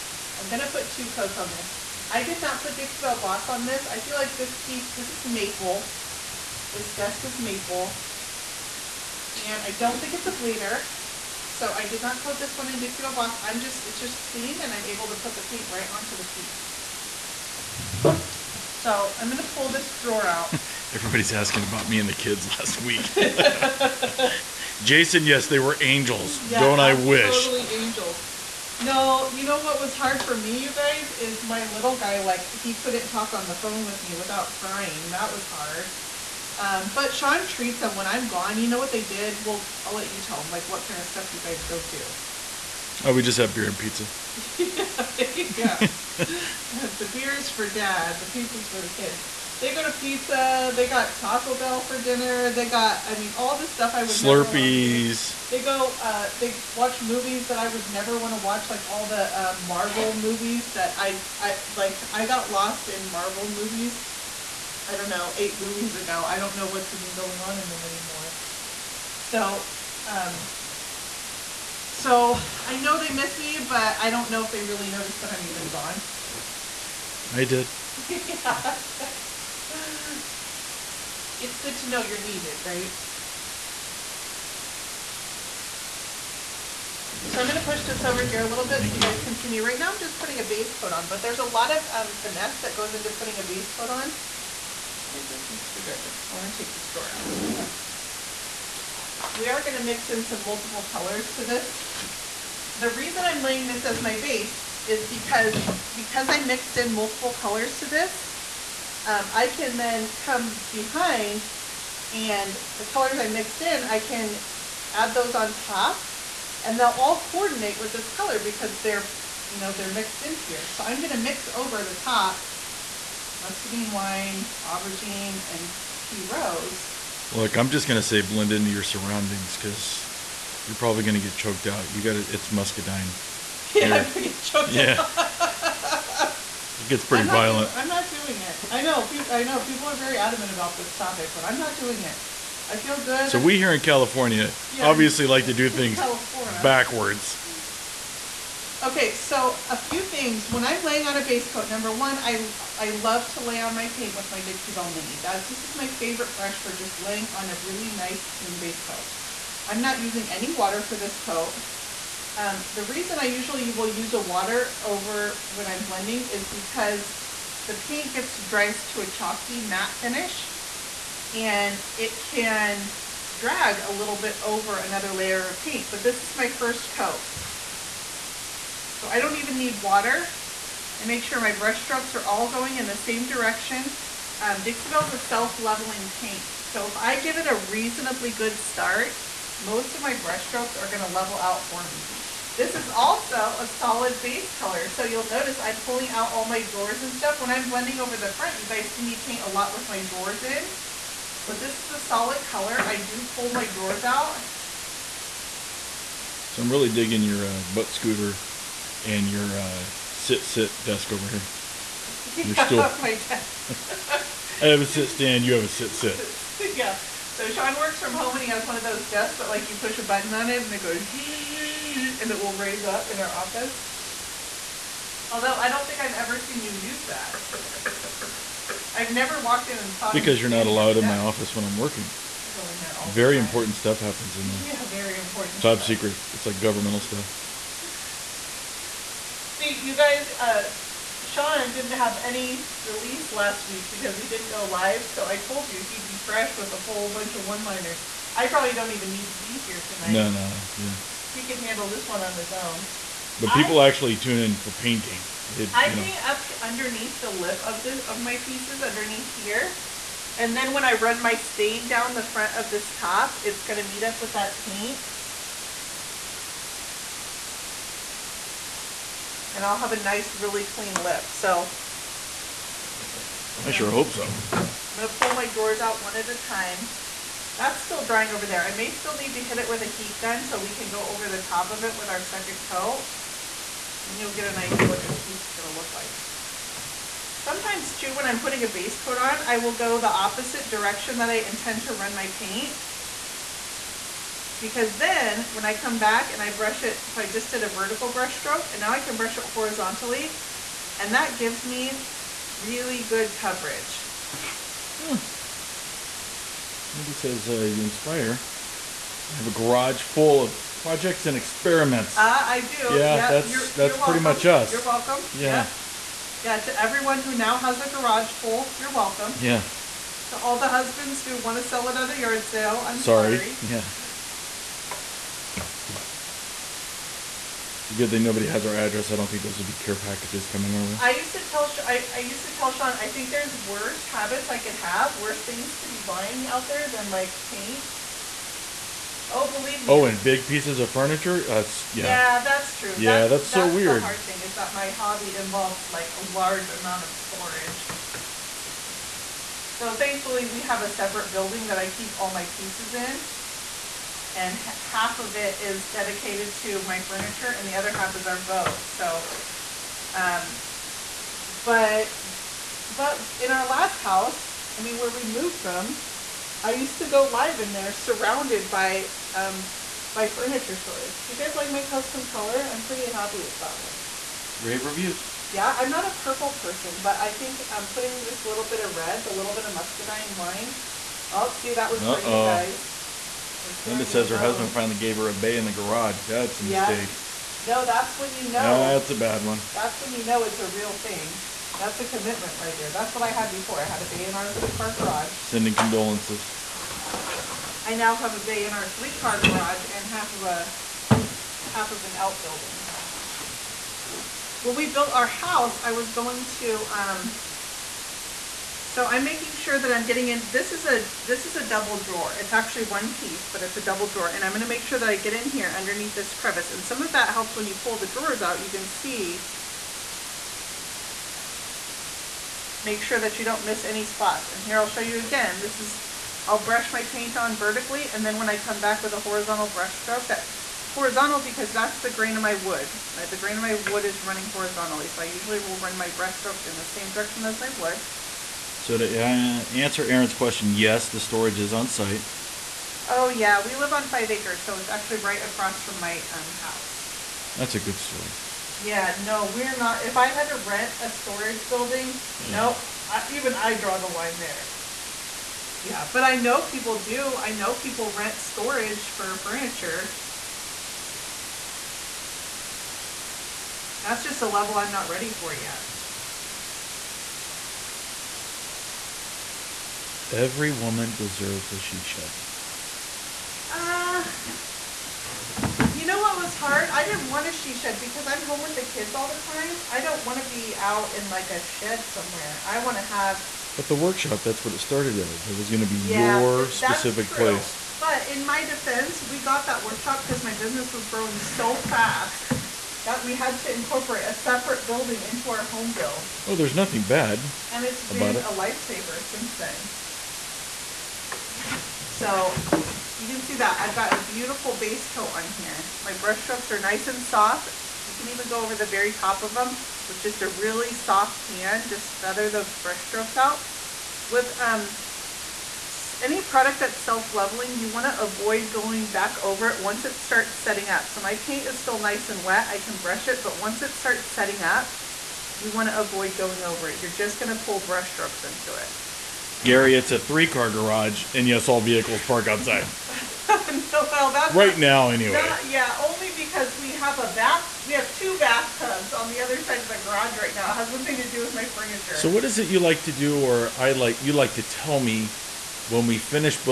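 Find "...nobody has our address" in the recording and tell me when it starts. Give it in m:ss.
5:28.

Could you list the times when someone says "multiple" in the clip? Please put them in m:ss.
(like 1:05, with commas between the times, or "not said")
1:40, 1:46.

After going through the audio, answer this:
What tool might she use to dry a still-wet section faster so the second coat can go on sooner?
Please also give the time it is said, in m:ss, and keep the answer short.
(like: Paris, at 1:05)
Heat gun, at 4:39.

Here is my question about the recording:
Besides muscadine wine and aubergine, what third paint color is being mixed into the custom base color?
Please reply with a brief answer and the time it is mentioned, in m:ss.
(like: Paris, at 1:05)
Tea rose, at 2:05.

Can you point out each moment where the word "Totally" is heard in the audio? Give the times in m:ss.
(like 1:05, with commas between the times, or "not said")
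0:27.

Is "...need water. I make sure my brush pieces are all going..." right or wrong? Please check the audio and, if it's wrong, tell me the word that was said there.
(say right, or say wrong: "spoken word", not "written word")
wrong: "strokes", not "pieces".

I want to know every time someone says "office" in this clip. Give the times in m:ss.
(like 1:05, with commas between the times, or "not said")
3:43, 3:51.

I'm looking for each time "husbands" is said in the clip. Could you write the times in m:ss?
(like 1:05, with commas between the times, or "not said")
5:20, 6:24.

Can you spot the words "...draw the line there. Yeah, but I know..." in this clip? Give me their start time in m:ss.
7:33.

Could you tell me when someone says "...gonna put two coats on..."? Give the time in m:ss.
0:00.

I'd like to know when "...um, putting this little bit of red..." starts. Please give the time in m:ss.
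6:17.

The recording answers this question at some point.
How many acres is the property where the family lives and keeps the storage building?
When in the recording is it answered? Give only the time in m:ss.
7:24.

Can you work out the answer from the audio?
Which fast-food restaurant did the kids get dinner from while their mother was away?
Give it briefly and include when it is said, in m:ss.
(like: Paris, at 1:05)
Taco Bell, at 0:51.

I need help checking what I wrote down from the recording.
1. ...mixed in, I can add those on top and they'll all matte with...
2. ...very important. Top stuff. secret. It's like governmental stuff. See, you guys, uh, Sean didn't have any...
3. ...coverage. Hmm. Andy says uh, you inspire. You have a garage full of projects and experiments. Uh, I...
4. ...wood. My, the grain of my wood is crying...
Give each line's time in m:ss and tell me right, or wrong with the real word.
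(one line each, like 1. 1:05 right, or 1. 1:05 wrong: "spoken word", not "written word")
1. 1:53 wrong: "coordinate", not "matte"
2. 3:54 right
3. 5:03 right
4. 7:12 wrong: "running", not "crying".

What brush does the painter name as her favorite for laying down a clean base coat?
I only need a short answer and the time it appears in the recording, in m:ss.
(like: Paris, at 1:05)
Dixie Belle Mini, at 2:34.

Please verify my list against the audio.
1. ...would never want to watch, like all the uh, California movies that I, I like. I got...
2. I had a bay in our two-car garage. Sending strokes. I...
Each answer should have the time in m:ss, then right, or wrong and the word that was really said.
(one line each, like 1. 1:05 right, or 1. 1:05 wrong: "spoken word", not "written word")
1. 0:57 wrong: "Marvel", not "California"
2. 6:33 wrong: "condolences", not "strokes".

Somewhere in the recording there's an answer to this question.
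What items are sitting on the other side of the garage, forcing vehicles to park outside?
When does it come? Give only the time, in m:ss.
8:58.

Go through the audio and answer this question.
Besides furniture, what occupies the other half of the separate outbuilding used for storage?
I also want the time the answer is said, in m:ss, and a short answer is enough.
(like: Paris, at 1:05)
Boat, at 5:58.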